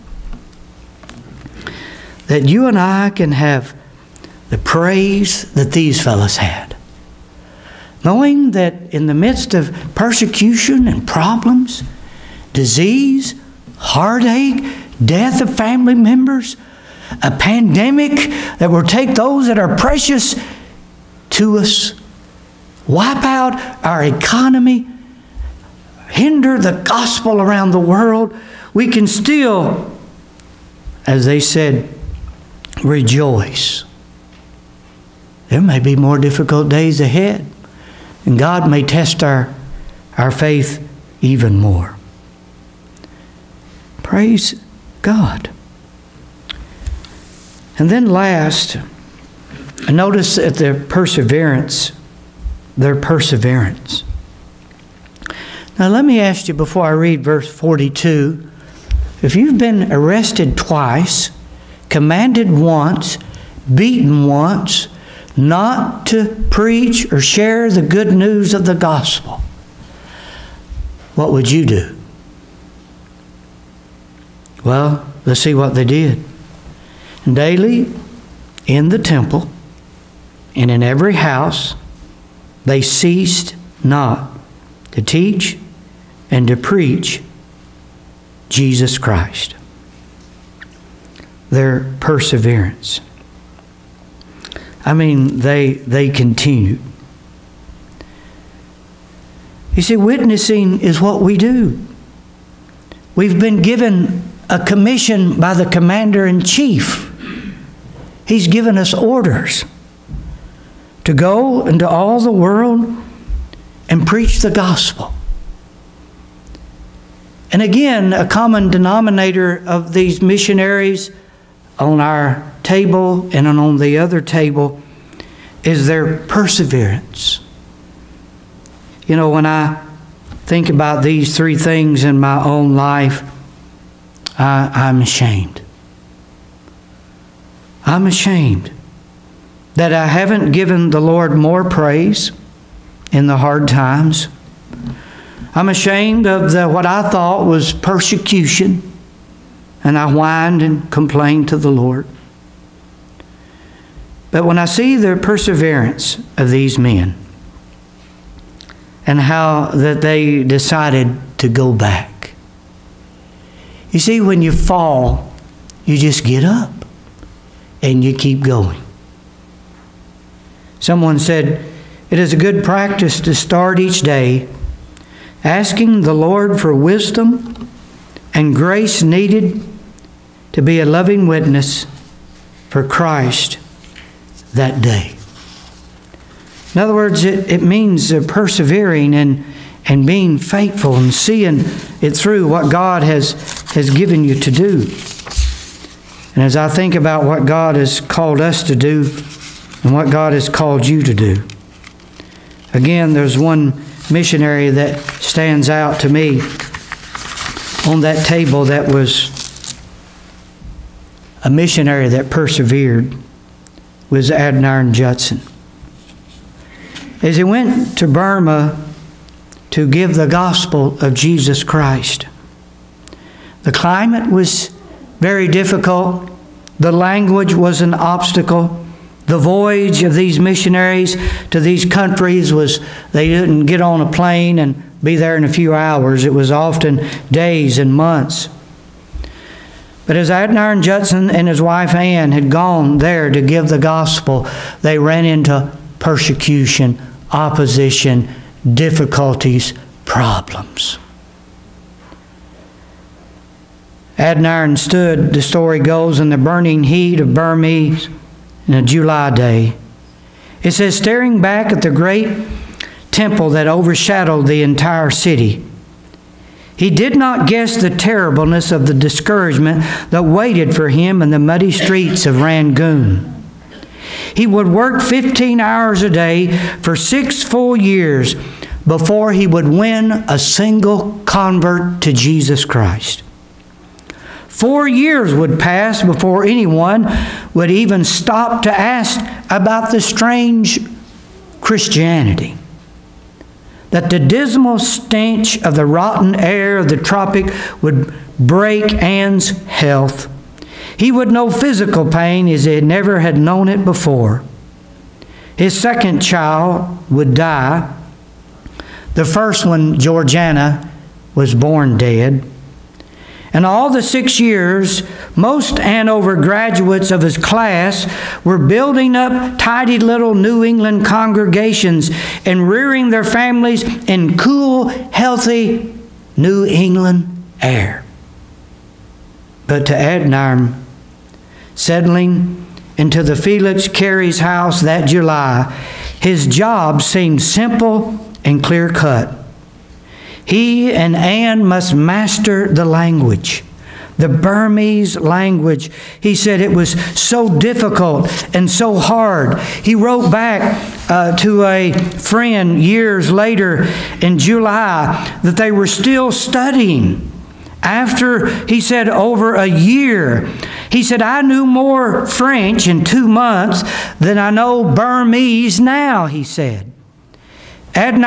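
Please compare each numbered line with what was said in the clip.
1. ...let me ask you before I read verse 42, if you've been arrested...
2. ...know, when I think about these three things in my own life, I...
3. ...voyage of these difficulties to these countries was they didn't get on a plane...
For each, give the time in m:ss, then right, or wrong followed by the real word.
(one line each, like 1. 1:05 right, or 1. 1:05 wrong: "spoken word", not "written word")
1. 0:55 right
2. 2:09 right
3. 3:49 wrong: "missionaries", not "difficulties".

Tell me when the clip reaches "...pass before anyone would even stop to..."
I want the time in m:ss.
4:45.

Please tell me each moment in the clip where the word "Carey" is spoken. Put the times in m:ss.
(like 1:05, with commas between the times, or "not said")
5:33.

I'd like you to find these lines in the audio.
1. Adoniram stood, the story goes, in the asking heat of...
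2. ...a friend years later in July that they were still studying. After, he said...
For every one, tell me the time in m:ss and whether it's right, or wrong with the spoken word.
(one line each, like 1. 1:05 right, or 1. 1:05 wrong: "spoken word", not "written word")
1. 4:14 wrong: "burning", not "asking"
2. 5:51 right.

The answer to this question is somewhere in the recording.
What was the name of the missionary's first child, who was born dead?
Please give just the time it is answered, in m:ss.
5:09.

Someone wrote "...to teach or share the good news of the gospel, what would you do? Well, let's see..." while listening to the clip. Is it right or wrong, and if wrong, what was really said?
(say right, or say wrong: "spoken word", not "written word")
wrong: "preach", not "teach".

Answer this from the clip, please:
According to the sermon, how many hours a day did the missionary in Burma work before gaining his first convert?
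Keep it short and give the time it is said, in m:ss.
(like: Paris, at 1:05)
15, at 4:35.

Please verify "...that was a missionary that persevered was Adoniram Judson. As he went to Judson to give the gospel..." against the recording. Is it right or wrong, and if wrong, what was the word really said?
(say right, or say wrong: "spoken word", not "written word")
wrong: "Burma", not "Judson".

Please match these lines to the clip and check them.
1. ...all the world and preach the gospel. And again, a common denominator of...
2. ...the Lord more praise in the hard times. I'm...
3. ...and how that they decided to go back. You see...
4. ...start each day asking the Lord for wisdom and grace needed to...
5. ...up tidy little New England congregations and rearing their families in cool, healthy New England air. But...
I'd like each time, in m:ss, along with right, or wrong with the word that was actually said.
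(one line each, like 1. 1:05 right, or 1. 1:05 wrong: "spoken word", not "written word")
1. 1:51 right
2. 2:20 right
3. 2:39 right
4. 2:53 right
5. 5:19 right.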